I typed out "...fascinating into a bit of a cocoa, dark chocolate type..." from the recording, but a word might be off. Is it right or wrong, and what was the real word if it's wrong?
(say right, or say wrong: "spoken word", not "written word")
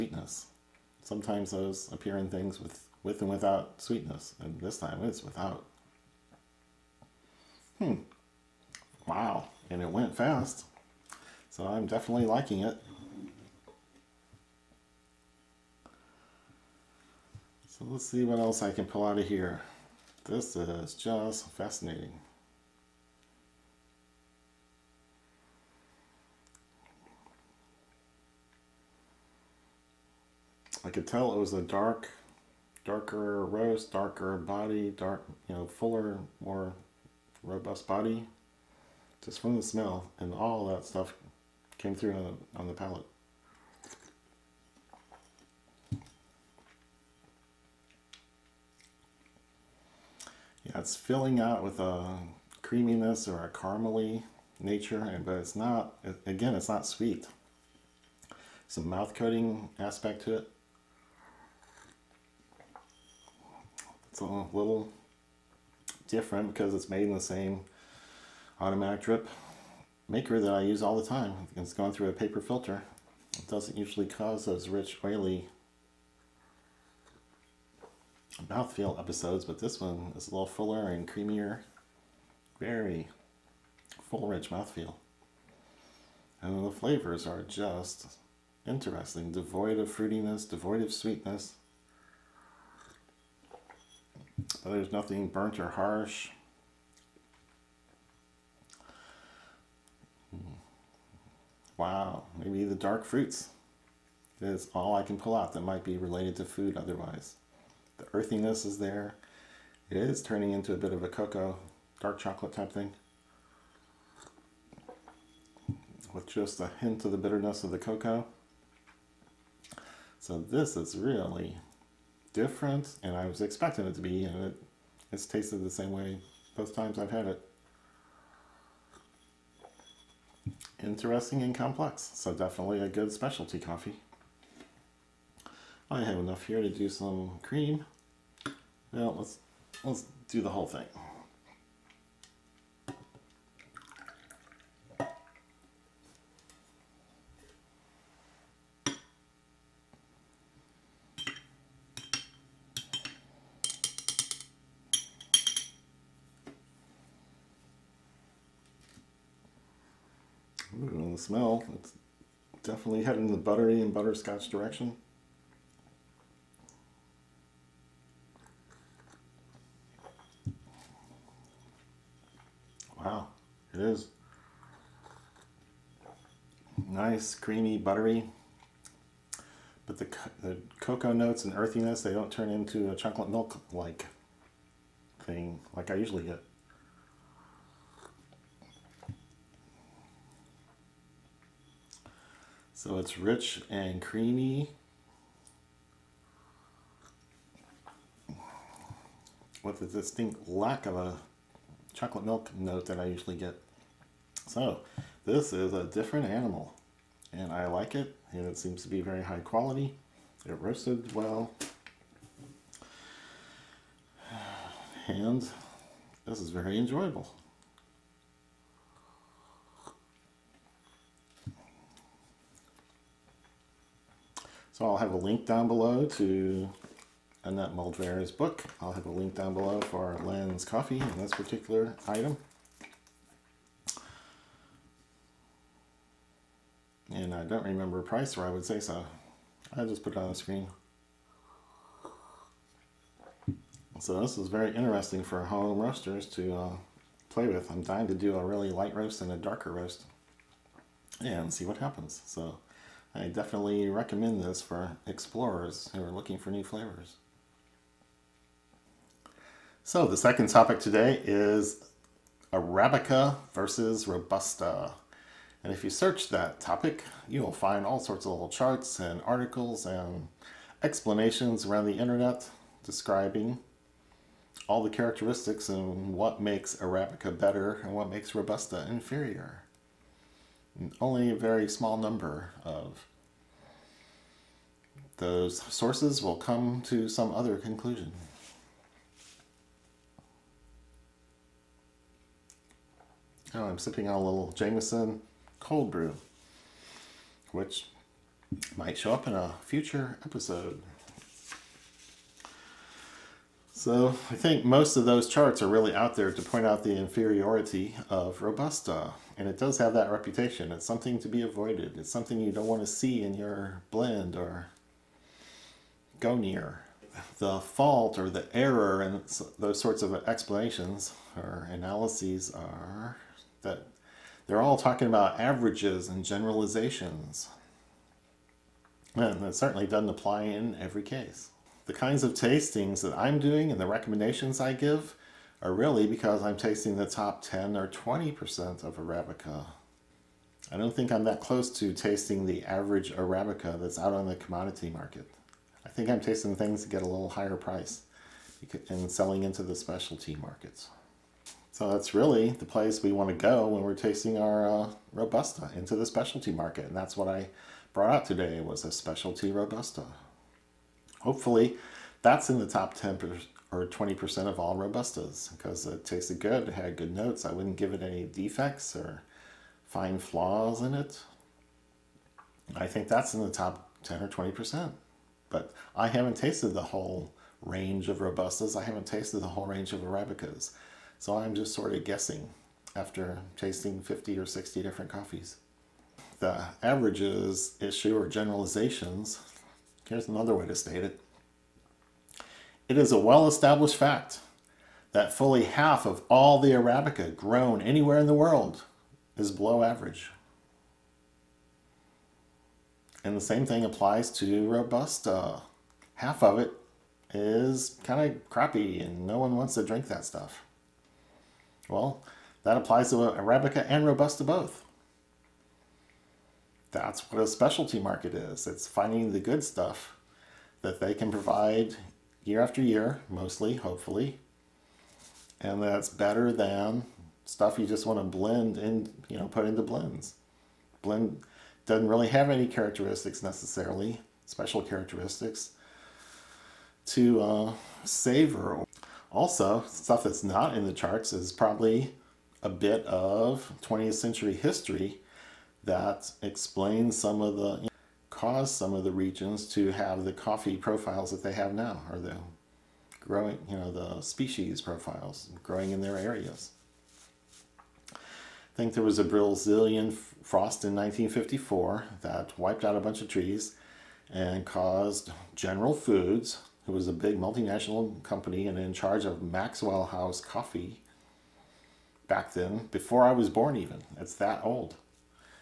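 wrong: "turning", not "fascinating".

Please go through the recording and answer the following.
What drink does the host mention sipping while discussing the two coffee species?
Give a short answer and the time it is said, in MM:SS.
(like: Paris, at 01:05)
Jameson cold brew, at 04:54.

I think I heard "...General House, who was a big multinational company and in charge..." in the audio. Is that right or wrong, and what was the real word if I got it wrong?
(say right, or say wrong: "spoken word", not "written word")
wrong: "Foods", not "House".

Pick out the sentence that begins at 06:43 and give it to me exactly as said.
And the same thing applies to Robusta.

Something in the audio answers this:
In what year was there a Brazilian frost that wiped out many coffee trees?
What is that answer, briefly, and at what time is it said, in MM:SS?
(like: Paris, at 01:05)
1954, at 07:40.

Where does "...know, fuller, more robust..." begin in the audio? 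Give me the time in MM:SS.
00:35.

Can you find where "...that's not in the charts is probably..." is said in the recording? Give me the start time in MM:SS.
07:20.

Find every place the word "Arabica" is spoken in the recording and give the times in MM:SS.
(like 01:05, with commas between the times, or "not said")
04:22, 04:36, 05:38, 05:43, 06:19, 06:36, 06:53.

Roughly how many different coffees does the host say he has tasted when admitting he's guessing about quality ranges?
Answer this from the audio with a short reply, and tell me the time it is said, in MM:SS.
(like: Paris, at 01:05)
50 or 60, at 06:23.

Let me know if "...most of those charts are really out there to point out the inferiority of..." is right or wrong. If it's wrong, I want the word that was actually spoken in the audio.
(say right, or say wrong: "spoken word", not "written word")
right.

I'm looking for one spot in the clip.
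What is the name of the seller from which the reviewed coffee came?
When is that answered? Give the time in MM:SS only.
03:50.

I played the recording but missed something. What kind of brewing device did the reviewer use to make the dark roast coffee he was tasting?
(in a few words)
Automatic drip maker.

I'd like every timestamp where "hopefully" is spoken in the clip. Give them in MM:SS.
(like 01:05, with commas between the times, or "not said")
06:01, 07:03.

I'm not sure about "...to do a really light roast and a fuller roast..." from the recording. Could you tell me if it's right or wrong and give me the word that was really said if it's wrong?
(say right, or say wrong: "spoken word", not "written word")
wrong: "darker", not "fuller".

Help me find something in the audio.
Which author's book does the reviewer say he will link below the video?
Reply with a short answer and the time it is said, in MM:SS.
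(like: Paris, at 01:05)
Annette Moldvaer, at 03:47.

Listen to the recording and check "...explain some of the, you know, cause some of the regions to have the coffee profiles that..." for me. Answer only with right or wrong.
right.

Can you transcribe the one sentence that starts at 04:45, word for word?
Those sources will come to some other conclusion.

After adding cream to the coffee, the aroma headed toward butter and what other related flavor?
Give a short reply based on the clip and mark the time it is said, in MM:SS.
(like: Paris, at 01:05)
Butterscotch, at 02:43.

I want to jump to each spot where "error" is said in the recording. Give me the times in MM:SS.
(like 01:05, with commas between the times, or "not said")
05:18.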